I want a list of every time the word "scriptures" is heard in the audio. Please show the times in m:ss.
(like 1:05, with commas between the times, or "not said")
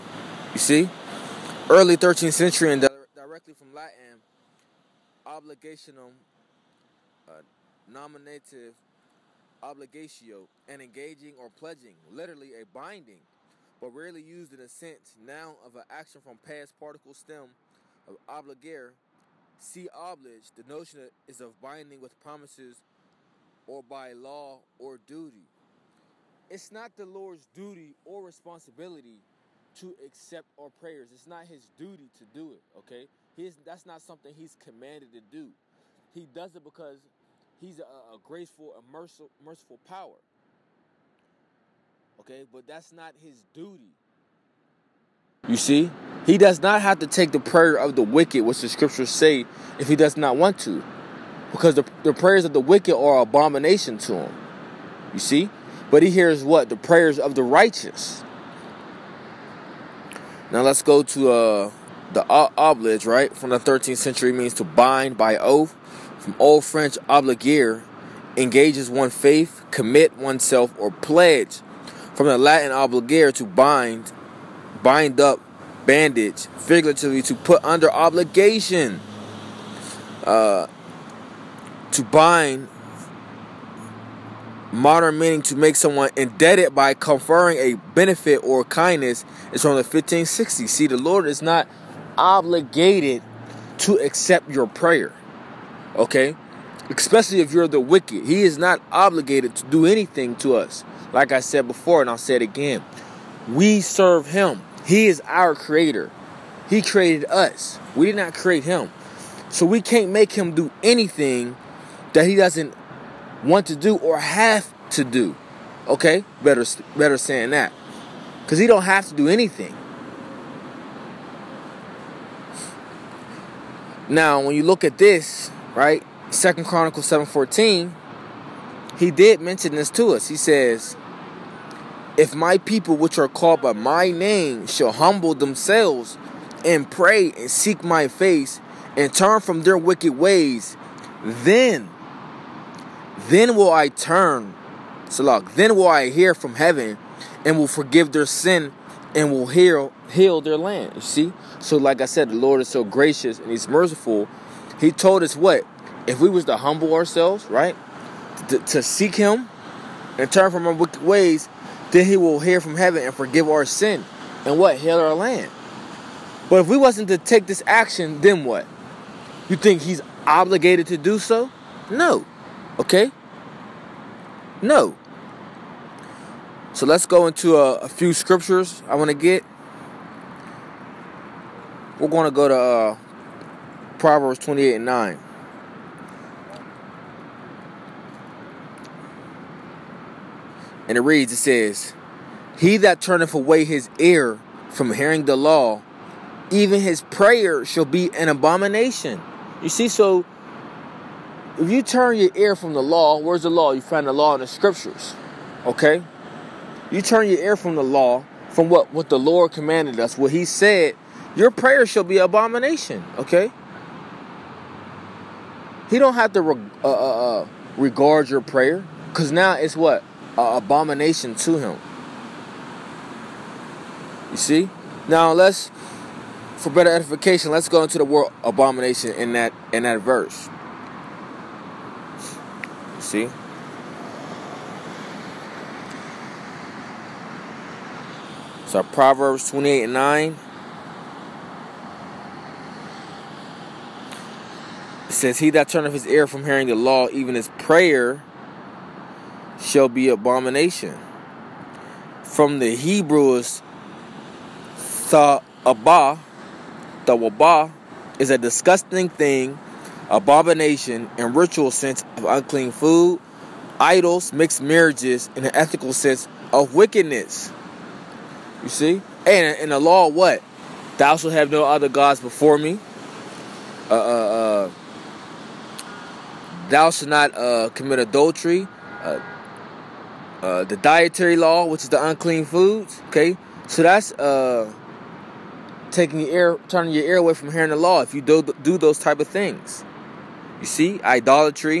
0:48, 2:58, 3:24.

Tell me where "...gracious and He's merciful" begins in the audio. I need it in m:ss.
2:32.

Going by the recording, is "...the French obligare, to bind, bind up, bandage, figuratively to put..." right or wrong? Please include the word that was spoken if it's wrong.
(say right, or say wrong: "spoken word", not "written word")
wrong: "Latin", not "French".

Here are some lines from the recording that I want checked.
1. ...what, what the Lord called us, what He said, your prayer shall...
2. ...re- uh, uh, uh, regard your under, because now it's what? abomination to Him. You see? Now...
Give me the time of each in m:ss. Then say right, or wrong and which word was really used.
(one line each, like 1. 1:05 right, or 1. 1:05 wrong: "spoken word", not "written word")
1. 3:28 wrong: "commanded", not "called"
2. 3:36 wrong: "prayer", not "under".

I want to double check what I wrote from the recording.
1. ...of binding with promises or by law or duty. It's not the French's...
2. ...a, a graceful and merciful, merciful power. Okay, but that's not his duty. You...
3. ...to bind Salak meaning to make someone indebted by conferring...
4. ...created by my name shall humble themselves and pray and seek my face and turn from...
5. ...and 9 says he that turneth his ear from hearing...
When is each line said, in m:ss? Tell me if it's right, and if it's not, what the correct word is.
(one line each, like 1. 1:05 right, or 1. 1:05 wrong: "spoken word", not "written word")
1. 0:21 wrong: "Lord", not "French"
2. 0:37 right
3. 1:21 wrong: "Modern", not "Salak"
4. 2:13 wrong: "called", not "created"
5. 3:59 right.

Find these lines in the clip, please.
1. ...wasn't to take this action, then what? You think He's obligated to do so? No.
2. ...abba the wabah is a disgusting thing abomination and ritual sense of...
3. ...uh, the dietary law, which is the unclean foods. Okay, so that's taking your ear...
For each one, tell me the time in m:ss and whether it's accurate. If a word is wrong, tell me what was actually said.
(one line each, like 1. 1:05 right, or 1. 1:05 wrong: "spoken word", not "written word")
1. 2:46 right
2. 4:15 right
3. 4:40 right.